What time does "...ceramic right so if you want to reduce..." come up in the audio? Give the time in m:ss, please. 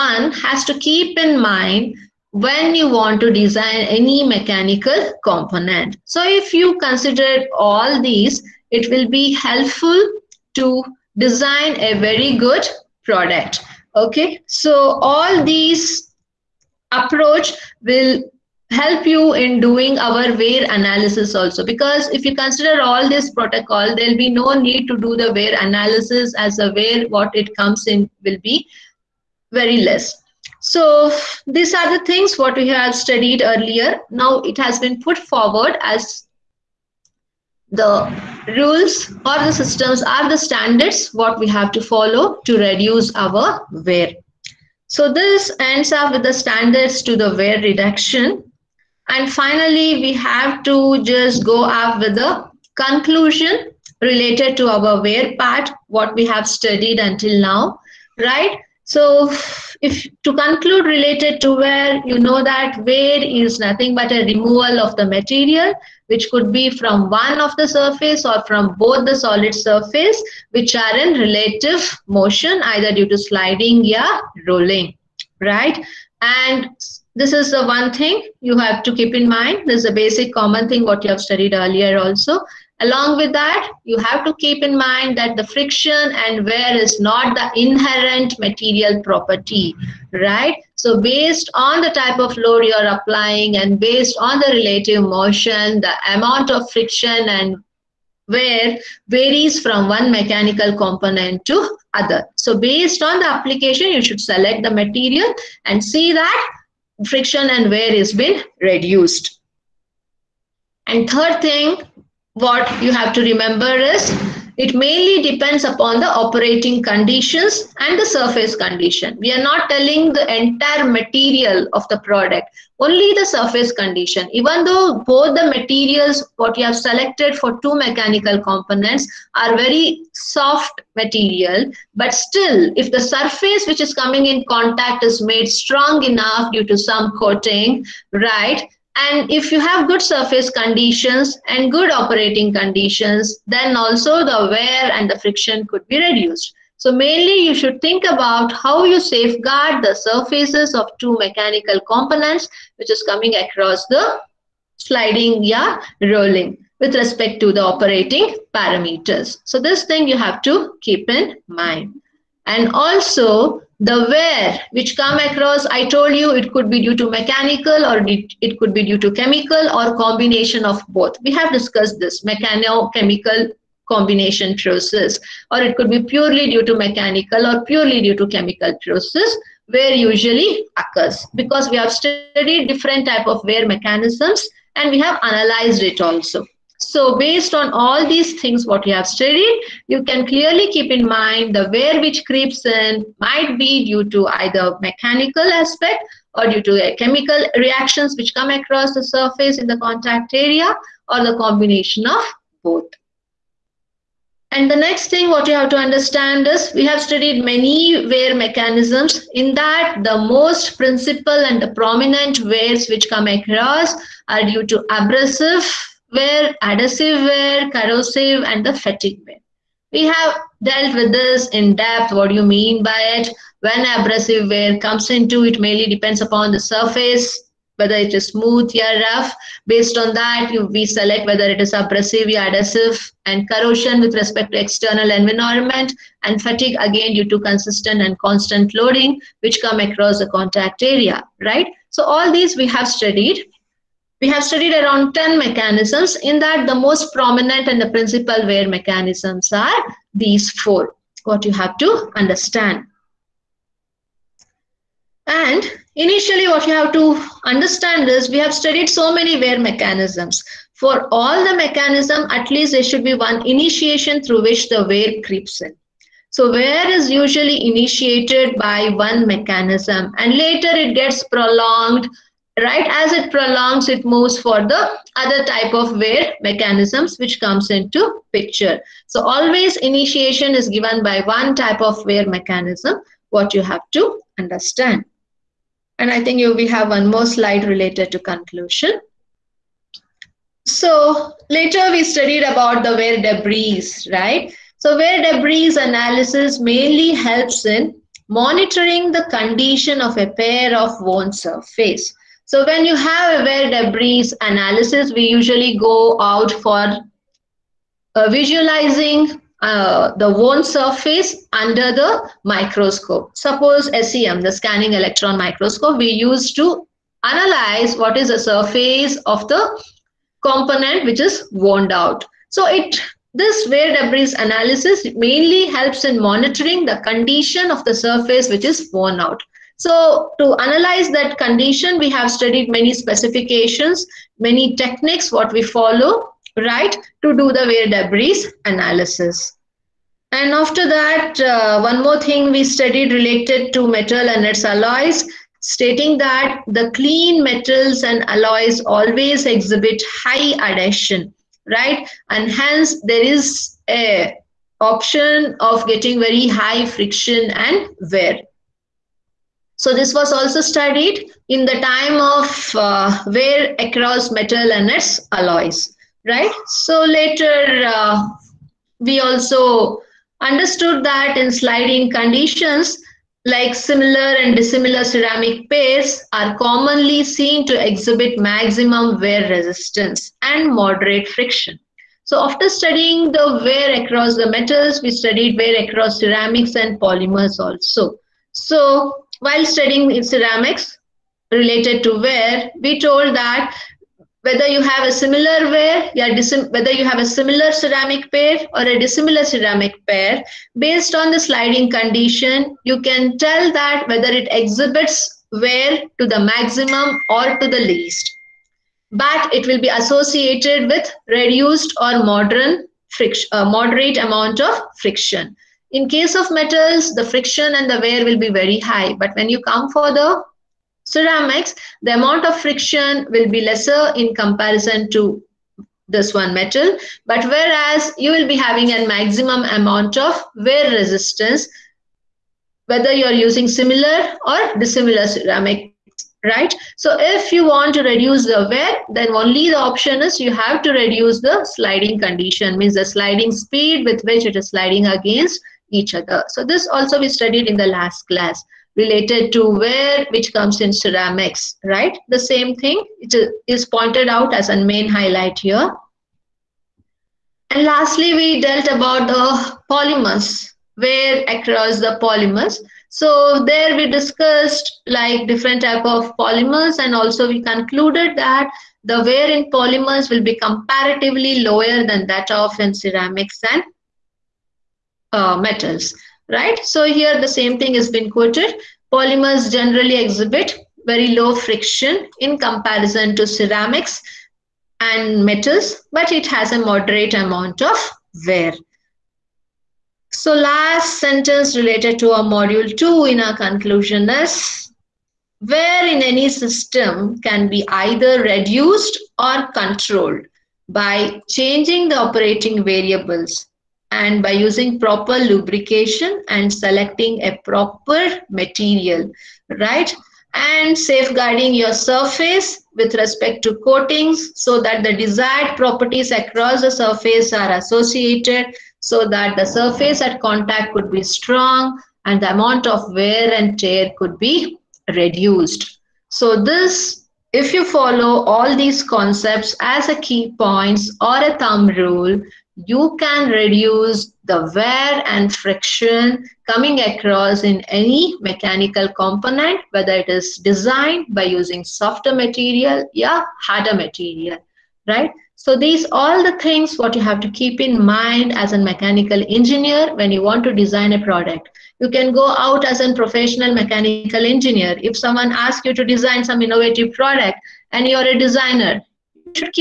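7:15.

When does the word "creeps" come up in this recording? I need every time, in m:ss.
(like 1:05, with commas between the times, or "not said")
3:12, 4:25.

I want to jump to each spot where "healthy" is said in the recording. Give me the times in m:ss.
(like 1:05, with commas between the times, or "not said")
not said.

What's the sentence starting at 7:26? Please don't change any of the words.
So this also we studied in the last class related to wear, which comes in ceramics, right?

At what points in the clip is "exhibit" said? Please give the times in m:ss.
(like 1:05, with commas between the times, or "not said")
5:49, 6:17, 6:44, 8:00.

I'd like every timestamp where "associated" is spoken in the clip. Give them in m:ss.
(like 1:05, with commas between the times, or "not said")
6:49, 8:37.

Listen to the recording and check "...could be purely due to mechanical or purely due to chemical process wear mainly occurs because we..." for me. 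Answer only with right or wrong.
wrong.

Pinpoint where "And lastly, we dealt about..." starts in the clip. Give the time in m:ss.
7:37.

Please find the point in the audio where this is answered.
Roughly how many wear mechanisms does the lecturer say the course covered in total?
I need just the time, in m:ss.
4:04.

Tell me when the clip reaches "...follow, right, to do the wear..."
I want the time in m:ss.
5:35.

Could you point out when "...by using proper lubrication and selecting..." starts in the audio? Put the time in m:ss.
8:24.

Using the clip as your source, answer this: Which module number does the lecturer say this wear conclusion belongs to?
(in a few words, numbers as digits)
2.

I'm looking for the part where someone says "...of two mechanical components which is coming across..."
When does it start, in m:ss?
2:30.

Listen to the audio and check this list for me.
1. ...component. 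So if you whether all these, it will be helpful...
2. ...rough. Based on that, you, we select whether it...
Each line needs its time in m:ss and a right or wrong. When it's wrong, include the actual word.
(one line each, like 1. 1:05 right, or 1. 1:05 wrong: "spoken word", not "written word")
1. 0:05 wrong: "consider", not "whether"
2. 3:49 right.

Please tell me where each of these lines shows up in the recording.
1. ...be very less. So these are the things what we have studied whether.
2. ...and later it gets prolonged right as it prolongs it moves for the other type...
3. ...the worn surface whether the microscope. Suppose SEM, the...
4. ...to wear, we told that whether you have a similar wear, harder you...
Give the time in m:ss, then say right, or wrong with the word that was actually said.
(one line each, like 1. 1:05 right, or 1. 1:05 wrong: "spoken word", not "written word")
1. 0:28 wrong: "earlier", not "whether"
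2. 4:30 right
3. 5:10 wrong: "under", not "whether"
4. 6:32 wrong: "whether", not "harder".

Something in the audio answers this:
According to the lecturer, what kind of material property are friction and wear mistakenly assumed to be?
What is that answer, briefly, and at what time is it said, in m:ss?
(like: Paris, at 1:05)
inherent material property, at 1:27.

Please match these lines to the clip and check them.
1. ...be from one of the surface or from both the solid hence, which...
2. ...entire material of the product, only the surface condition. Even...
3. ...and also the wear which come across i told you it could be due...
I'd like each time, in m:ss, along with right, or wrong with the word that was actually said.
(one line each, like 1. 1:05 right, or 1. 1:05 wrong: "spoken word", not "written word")
1. 1:06 wrong: "surface", not "hence"
2. 2:00 right
3. 2:42 right.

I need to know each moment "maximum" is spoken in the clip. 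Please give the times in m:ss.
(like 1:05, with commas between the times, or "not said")
6:18, 6:46, 7:09.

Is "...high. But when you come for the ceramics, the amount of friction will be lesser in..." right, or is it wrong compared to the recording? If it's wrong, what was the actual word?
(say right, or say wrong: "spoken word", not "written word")
right.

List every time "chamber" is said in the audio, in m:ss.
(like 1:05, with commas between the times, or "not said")
not said.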